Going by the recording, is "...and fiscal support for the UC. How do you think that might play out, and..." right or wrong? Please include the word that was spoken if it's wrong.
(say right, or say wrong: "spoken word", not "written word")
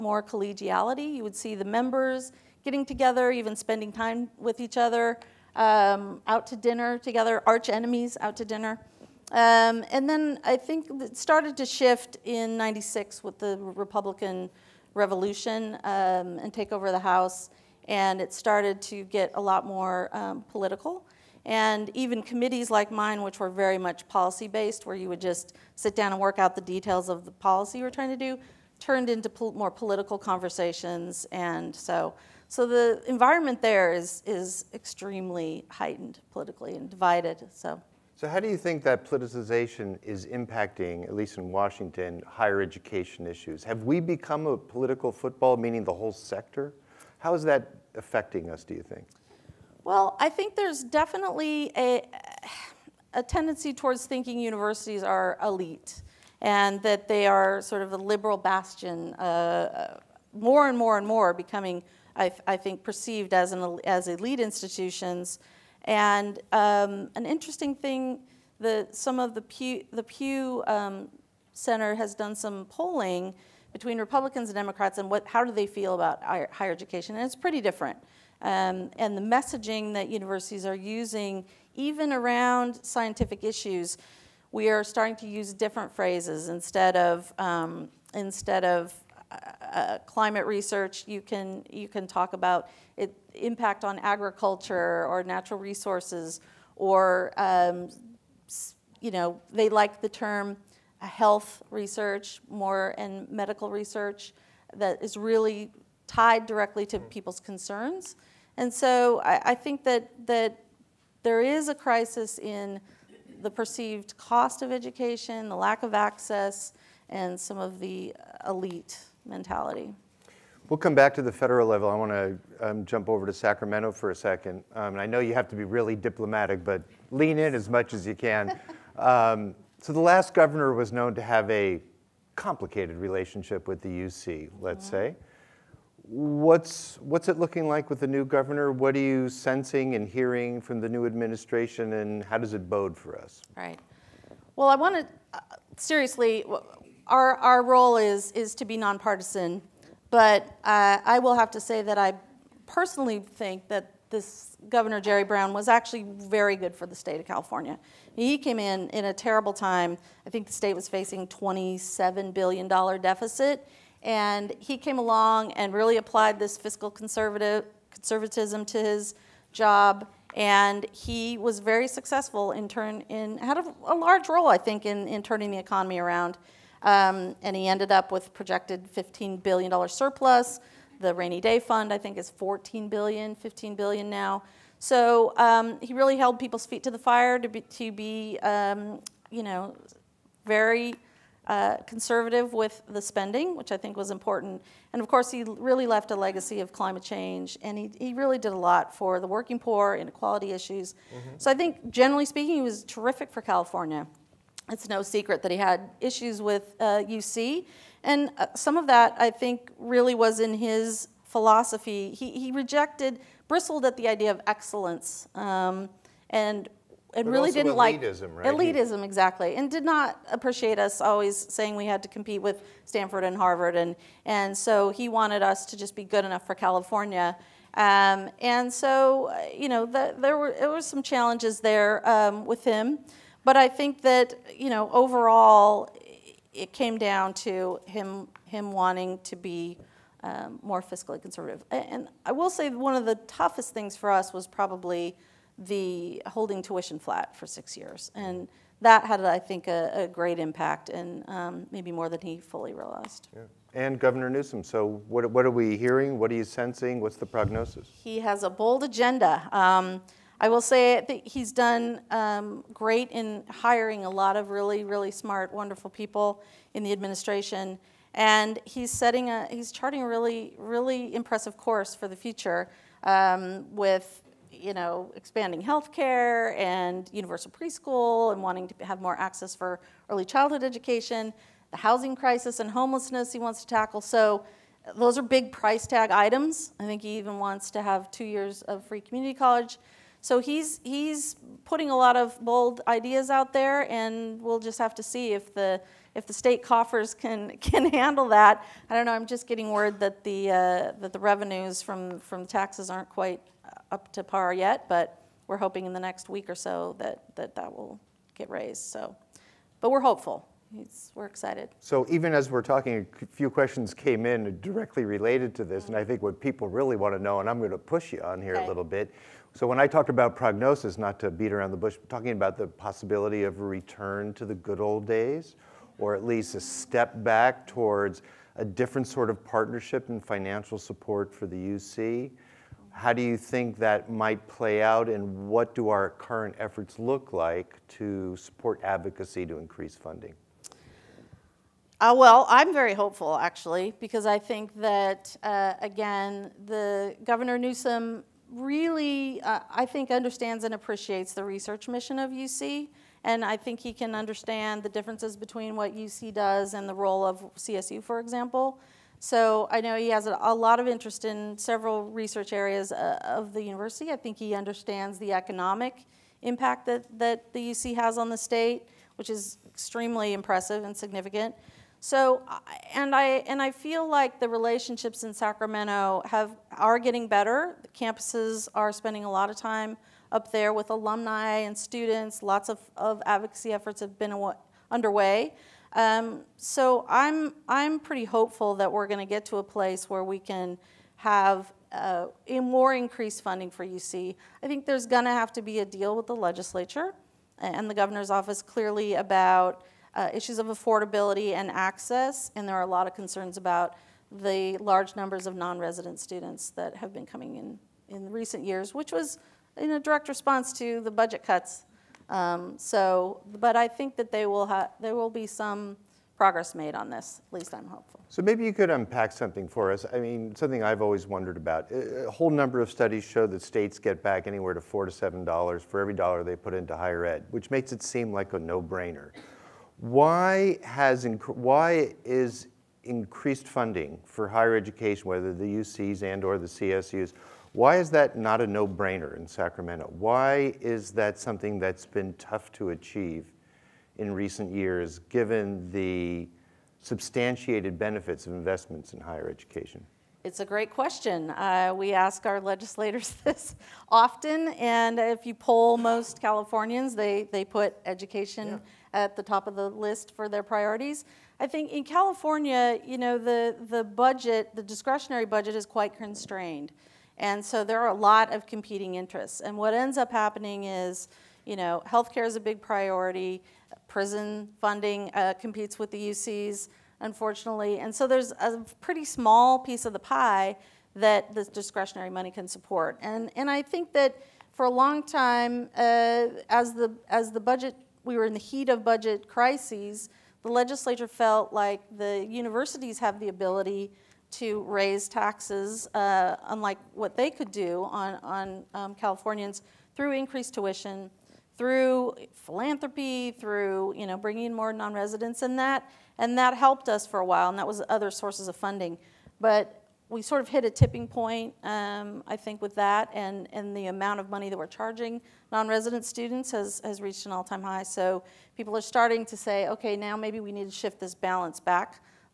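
wrong: "financial", not "fiscal".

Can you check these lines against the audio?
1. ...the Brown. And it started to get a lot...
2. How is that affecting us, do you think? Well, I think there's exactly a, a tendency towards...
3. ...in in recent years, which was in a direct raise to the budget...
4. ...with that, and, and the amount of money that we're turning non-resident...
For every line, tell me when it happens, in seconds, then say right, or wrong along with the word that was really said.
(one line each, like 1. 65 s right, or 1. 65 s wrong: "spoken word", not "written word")
1. 16 s wrong: "House", not "Brown"
2. 47 s wrong: "definitely", not "exactly"
3. 407 s wrong: "response", not "raise"
4. 512 s wrong: "charging", not "turning".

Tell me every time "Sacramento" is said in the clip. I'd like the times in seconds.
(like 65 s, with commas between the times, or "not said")
123 s, 375 s, 439 s.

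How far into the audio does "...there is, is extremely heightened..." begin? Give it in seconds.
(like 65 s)
33 s.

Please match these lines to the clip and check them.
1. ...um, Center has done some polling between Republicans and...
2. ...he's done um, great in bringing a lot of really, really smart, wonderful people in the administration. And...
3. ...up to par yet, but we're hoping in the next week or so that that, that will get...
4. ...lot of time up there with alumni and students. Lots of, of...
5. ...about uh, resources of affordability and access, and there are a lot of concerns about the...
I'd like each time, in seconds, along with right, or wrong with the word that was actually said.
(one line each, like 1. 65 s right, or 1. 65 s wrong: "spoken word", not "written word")
1. 70 s right
2. 261 s wrong: "hiring", not "bringing"
3. 303 s right
4. 379 s right
5. 399 s wrong: "issues", not "resources".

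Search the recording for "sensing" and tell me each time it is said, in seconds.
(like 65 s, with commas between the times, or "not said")
139 s, 256 s.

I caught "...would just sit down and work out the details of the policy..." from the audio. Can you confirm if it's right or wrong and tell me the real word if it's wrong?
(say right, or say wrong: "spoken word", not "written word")
right.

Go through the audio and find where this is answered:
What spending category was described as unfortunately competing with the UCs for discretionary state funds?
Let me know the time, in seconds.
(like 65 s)
474 s.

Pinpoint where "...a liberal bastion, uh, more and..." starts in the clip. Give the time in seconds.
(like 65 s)
57 s.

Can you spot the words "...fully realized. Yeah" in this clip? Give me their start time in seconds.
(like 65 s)
252 s.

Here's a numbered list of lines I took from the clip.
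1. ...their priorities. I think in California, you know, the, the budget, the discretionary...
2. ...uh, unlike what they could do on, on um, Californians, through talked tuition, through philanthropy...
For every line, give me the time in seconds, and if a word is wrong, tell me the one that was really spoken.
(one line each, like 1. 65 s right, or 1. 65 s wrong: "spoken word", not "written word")
1. 460 s right
2. 496 s wrong: "increased", not "talked".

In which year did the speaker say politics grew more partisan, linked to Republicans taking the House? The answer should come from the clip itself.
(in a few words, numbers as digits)
96.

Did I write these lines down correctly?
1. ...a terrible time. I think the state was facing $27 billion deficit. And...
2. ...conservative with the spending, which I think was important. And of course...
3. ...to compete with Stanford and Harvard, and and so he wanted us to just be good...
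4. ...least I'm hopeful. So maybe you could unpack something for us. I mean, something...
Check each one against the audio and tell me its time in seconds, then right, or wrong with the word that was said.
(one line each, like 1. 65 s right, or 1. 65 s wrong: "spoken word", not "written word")
1. 159 s right
2. 191 s right
3. 222 s right
4. 417 s right.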